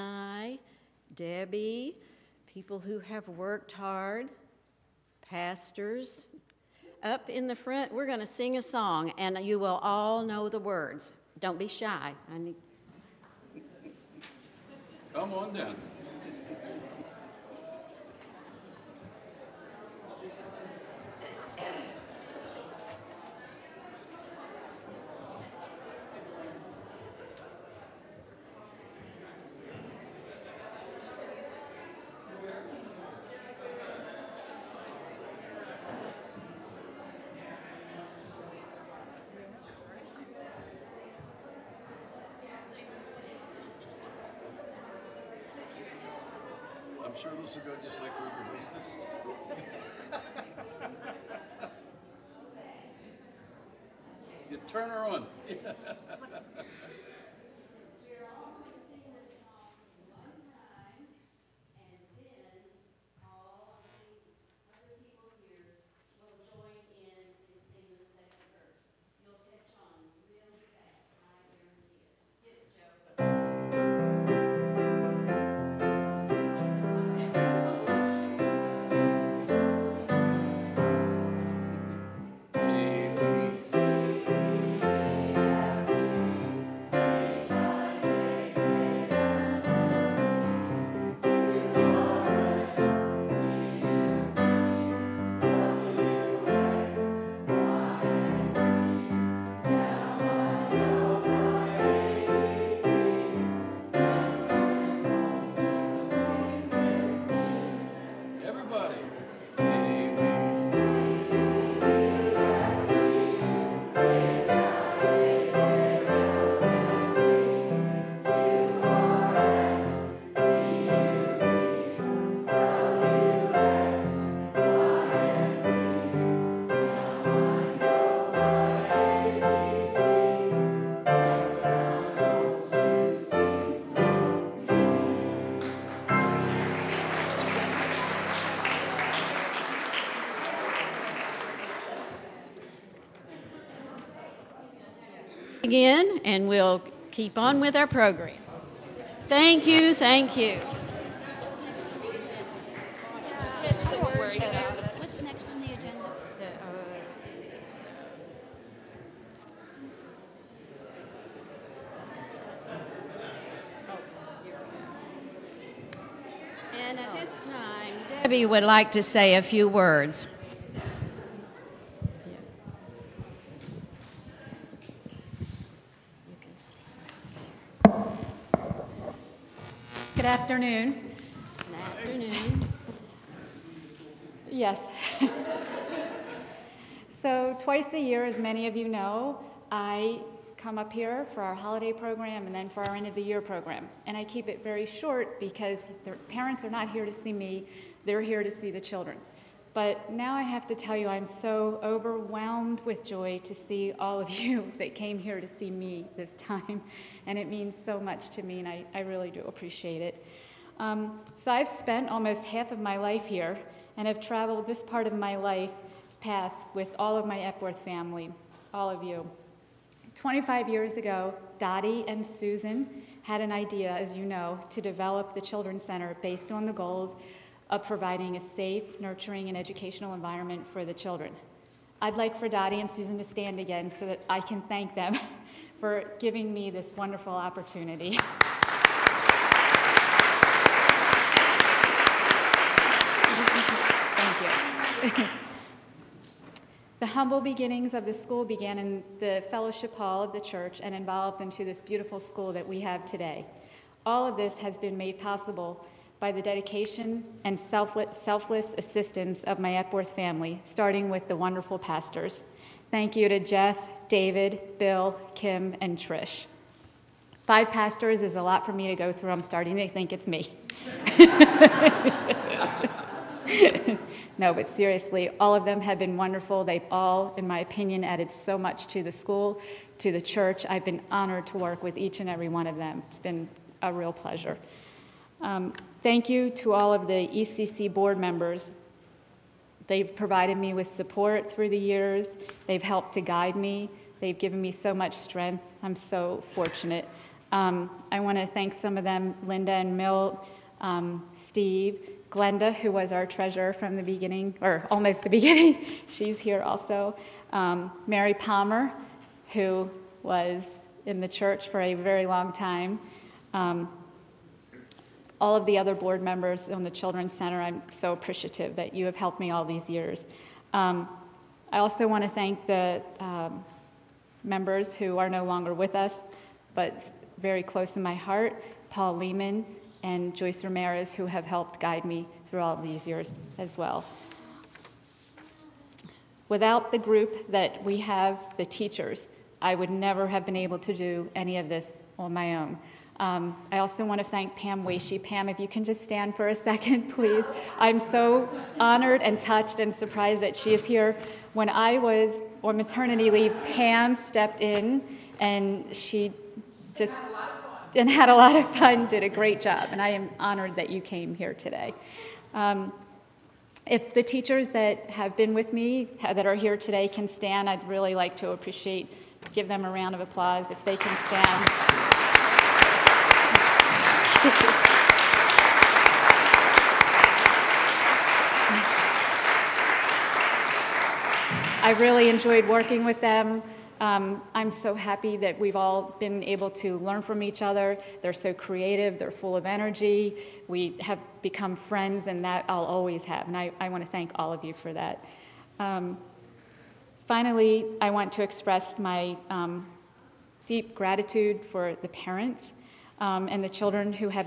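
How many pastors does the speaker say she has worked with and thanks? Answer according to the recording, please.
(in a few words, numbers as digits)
5.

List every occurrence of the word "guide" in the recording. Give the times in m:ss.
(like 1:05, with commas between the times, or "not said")
4:53, 5:31.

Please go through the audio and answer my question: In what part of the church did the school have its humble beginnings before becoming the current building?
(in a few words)
Fellowship hall.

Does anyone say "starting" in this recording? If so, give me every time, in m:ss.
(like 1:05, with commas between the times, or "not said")
4:20, 4:29.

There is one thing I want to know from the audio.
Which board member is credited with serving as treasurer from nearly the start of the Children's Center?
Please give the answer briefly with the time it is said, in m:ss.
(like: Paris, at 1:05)
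Glenda, at 5:02.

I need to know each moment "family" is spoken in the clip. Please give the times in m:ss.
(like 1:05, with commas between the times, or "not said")
3:37, 4:20.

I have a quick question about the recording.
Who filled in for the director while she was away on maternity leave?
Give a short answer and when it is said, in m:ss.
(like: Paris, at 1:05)
Pam Weishi, at 5:44.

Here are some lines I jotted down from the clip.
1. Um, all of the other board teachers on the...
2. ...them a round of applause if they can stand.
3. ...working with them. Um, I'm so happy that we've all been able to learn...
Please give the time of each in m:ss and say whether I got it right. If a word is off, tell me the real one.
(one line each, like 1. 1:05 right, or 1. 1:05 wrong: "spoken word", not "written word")
1. 5:13 wrong: "members", not "teachers"
2. 6:09 right
3. 6:22 right.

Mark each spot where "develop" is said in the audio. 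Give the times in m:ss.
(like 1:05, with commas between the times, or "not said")
3:44.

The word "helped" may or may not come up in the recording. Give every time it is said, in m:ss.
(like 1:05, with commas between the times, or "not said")
4:52, 5:19, 5:31.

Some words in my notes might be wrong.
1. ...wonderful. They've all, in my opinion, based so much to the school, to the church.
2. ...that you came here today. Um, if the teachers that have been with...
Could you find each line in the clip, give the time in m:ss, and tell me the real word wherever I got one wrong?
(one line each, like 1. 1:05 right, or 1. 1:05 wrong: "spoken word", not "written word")
1. 4:36 wrong: "added", not "based"
2. 6:00 right.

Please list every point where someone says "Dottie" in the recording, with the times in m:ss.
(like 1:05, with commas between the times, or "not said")
3:41, 3:52.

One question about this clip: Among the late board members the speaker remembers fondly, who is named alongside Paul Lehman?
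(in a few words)
Joyce Ramirez.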